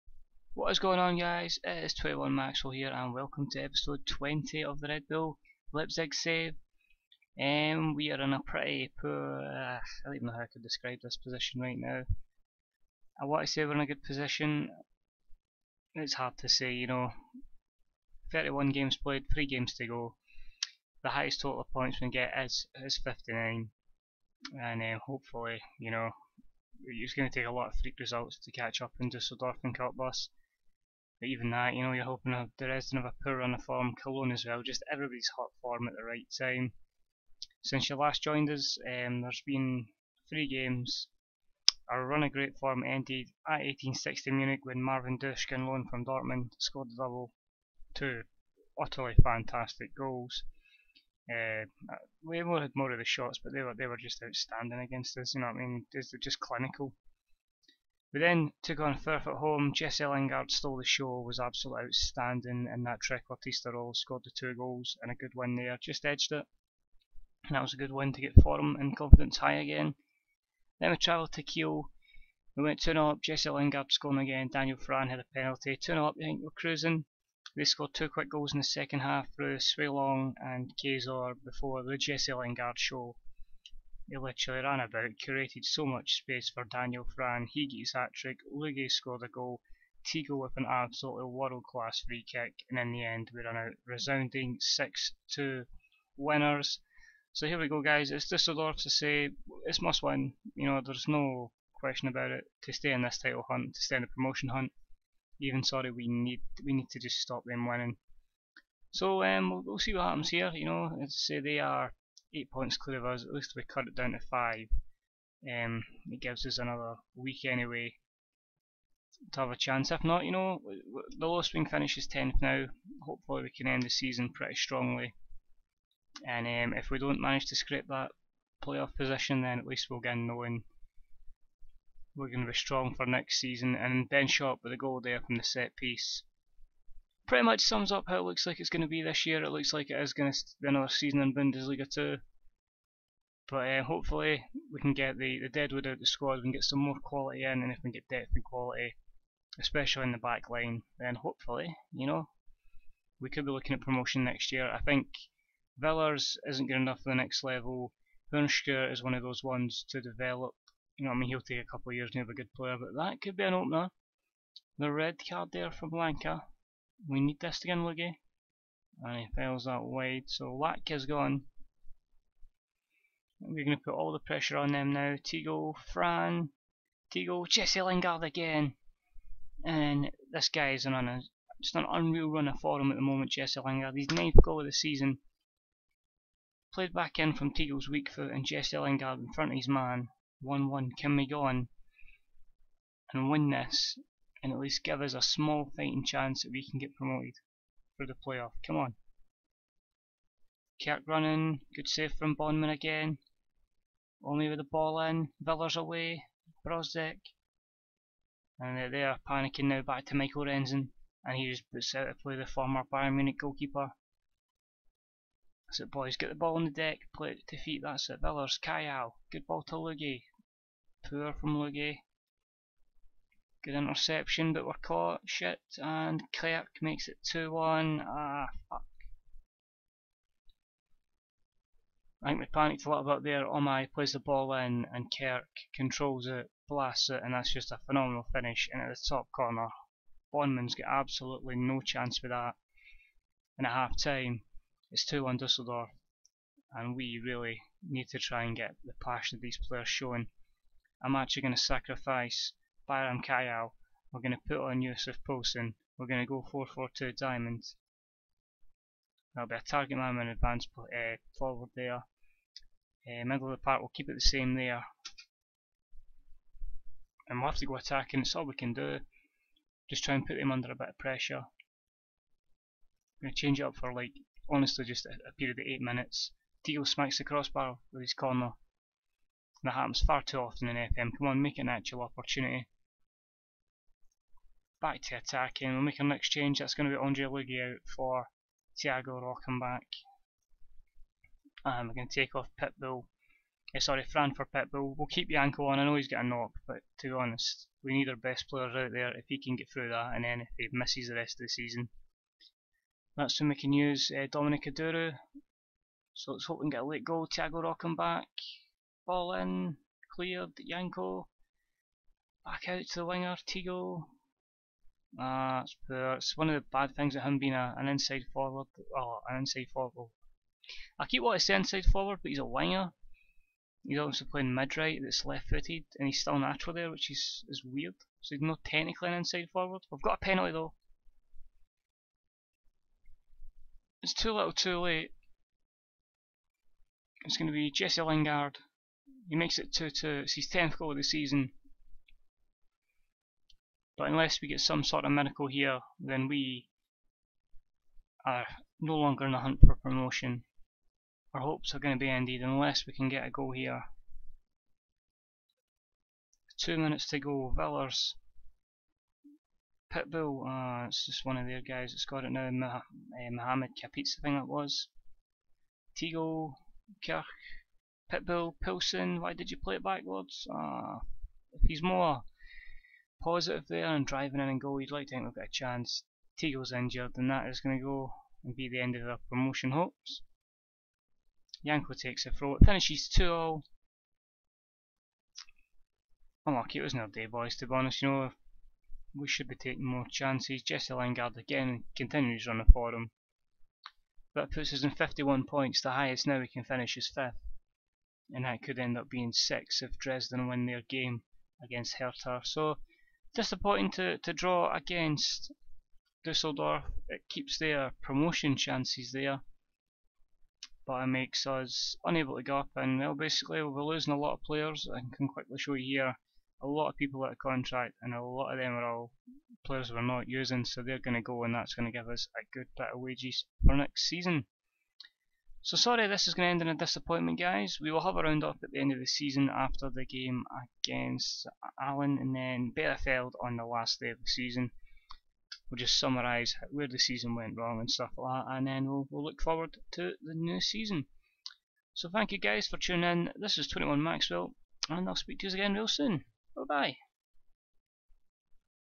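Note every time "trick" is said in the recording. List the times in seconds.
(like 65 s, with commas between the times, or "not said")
62 s, 87 s.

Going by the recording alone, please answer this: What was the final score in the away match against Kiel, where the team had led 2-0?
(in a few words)
6-2.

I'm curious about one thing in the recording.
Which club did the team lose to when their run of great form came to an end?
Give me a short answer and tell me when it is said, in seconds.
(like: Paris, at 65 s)
1860 Munich, at 43 s.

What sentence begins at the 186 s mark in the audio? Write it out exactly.
Played back in from Teagle's weak foot and Jesse Lingard in front of his man.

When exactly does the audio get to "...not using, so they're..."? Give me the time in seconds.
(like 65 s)
420 s.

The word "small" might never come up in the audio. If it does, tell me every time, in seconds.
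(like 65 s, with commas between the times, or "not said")
195 s.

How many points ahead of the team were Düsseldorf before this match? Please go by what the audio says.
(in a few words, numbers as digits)
8.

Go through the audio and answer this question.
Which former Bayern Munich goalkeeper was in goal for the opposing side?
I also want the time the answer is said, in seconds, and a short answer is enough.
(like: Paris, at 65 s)
Michael Rensing, at 210 s.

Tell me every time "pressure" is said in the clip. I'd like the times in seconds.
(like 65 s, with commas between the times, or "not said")
174 s, 270 s.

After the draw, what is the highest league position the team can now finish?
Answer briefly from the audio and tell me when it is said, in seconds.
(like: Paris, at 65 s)
5th, at 397 s.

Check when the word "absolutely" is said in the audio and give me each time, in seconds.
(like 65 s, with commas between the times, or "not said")
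61 s, 90 s, 240 s.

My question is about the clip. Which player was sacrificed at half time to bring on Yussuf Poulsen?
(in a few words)
Bayram Kayal.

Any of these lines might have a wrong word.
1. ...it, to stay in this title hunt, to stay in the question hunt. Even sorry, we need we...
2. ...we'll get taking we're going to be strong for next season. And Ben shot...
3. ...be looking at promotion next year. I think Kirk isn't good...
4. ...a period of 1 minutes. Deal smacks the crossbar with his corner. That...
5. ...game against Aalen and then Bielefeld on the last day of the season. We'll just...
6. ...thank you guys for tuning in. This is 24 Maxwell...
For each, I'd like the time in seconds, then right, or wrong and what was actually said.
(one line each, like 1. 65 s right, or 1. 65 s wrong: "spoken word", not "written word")
1. 102 s wrong: "promotion", not "question"
2. 129 s wrong: "knowing", not "taking"
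3. 153 s wrong: "Villars", not "Kirk"
4. 275 s wrong: "8", not "1"
5. 430 s right
6. 442 s wrong: "21", not "24".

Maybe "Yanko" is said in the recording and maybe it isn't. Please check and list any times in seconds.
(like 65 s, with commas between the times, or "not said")
295 s, 310 s, 381 s.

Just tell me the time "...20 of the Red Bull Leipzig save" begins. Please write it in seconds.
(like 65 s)
4 s.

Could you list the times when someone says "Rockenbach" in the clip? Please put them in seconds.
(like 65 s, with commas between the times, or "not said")
289 s, 307 s.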